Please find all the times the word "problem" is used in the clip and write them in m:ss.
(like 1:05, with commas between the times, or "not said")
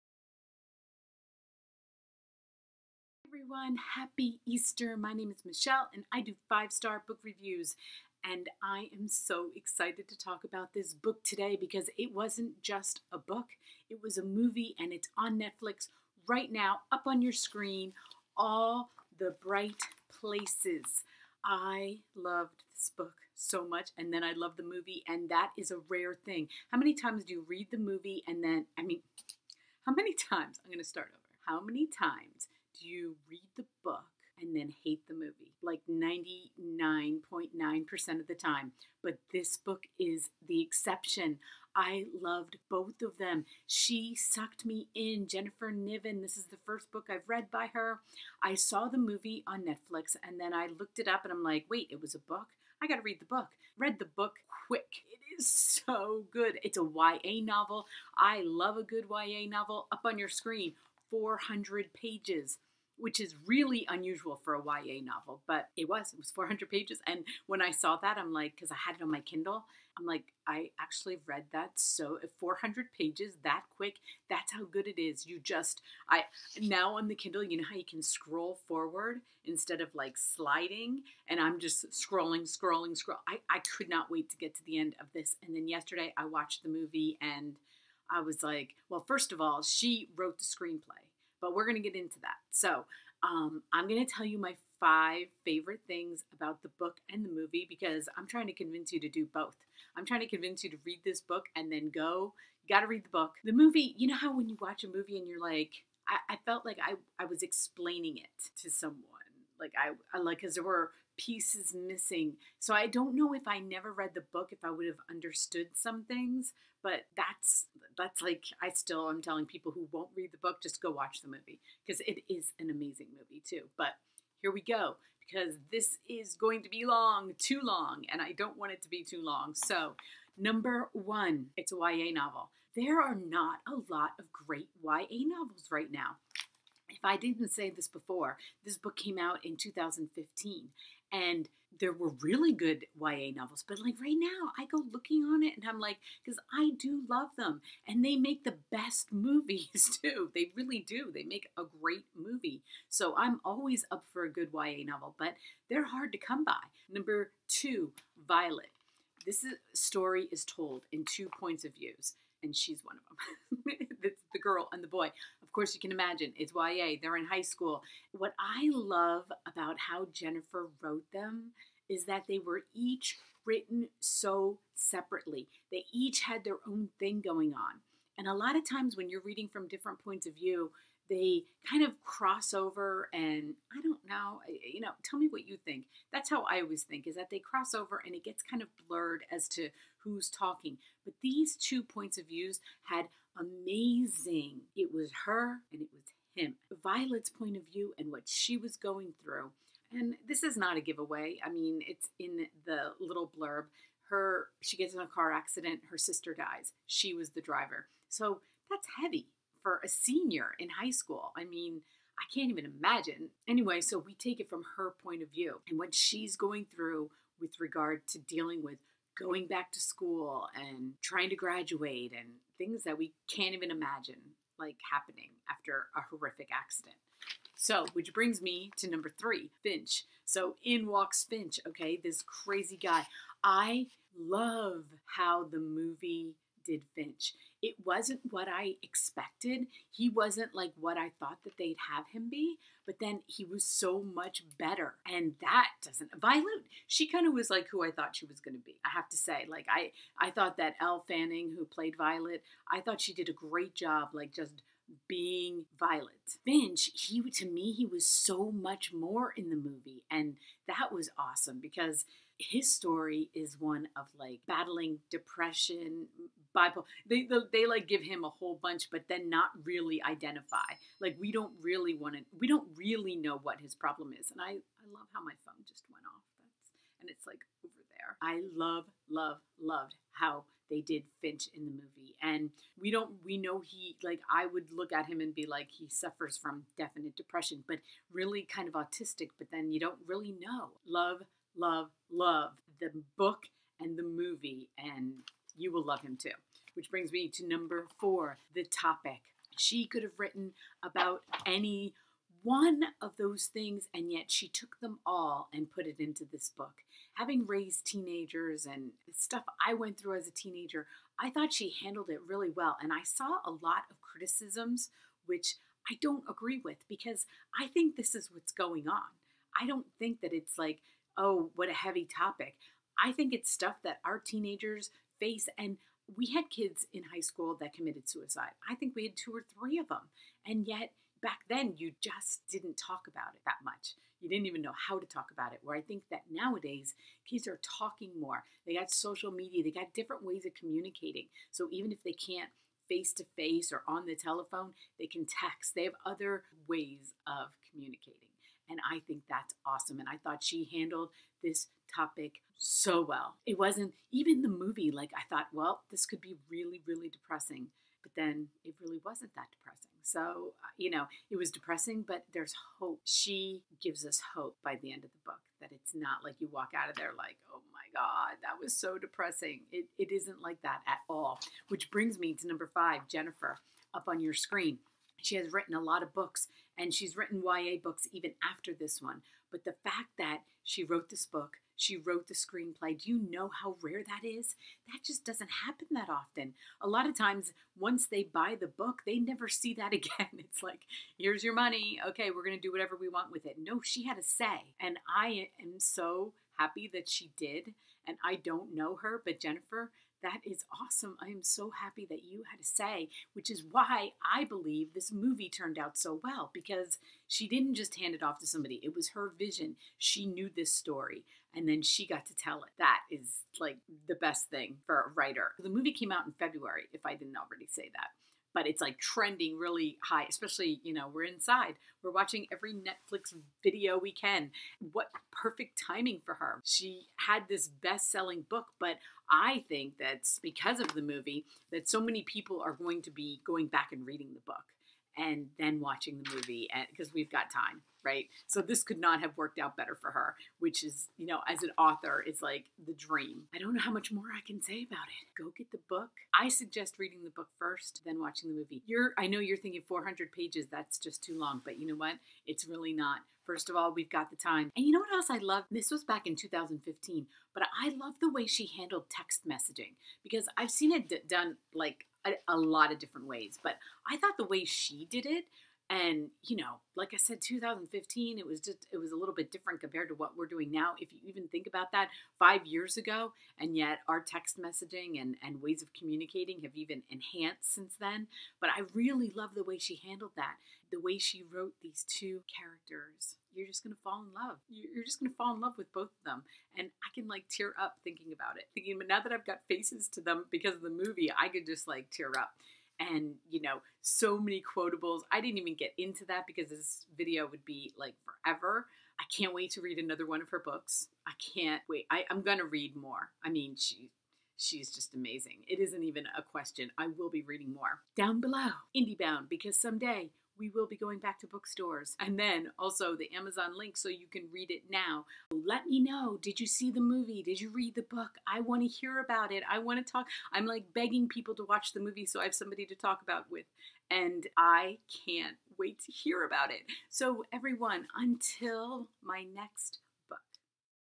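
4:33.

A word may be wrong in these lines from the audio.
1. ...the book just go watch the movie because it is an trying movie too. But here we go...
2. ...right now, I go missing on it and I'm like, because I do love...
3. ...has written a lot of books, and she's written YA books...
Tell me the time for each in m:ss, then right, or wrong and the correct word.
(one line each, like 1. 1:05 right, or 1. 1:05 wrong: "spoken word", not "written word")
1. 2:00 wrong: "amazing", not "trying"
2. 2:23 wrong: "looking", not "missing"
3. 6:15 right.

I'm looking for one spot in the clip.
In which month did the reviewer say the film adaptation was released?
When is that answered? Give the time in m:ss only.
6:56.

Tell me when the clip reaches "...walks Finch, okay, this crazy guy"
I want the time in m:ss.
3:50.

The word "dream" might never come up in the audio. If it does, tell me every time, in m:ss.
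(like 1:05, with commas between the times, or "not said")
7:22.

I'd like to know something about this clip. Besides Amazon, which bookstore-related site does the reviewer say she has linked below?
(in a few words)
IndieBound.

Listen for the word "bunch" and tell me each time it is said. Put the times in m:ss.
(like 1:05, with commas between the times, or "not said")
4:28.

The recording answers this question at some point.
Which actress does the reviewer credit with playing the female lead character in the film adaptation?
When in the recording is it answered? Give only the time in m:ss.
4:10.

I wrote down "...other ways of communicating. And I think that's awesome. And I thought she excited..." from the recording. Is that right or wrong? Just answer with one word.
wrong.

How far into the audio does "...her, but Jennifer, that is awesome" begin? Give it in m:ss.
6:38.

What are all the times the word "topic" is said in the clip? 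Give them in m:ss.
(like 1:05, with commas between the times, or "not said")
4:58, 5:22, 5:51.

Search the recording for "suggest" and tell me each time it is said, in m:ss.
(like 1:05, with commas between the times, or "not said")
7:26.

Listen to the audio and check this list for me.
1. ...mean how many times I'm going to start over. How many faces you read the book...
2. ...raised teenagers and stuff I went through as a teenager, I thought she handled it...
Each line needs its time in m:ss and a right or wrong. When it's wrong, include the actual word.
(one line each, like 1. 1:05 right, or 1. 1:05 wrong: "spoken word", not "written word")
1. 0:28 wrong: "times", not "faces"
2. 5:07 right.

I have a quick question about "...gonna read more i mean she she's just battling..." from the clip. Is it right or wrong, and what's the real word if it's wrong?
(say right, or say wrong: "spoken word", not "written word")
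wrong: "amazing", not "battling".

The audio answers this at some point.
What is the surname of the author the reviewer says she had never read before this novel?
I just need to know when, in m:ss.
0:45.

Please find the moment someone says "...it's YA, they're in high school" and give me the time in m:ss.
2:46.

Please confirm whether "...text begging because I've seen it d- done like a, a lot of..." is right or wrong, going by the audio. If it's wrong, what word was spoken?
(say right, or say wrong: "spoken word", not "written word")
wrong: "messaging", not "begging".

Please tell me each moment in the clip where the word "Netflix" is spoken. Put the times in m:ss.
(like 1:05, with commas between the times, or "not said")
0:15, 0:49, 7:02.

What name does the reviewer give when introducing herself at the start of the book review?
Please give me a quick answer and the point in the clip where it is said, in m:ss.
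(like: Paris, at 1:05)
Michelle, at 0:05.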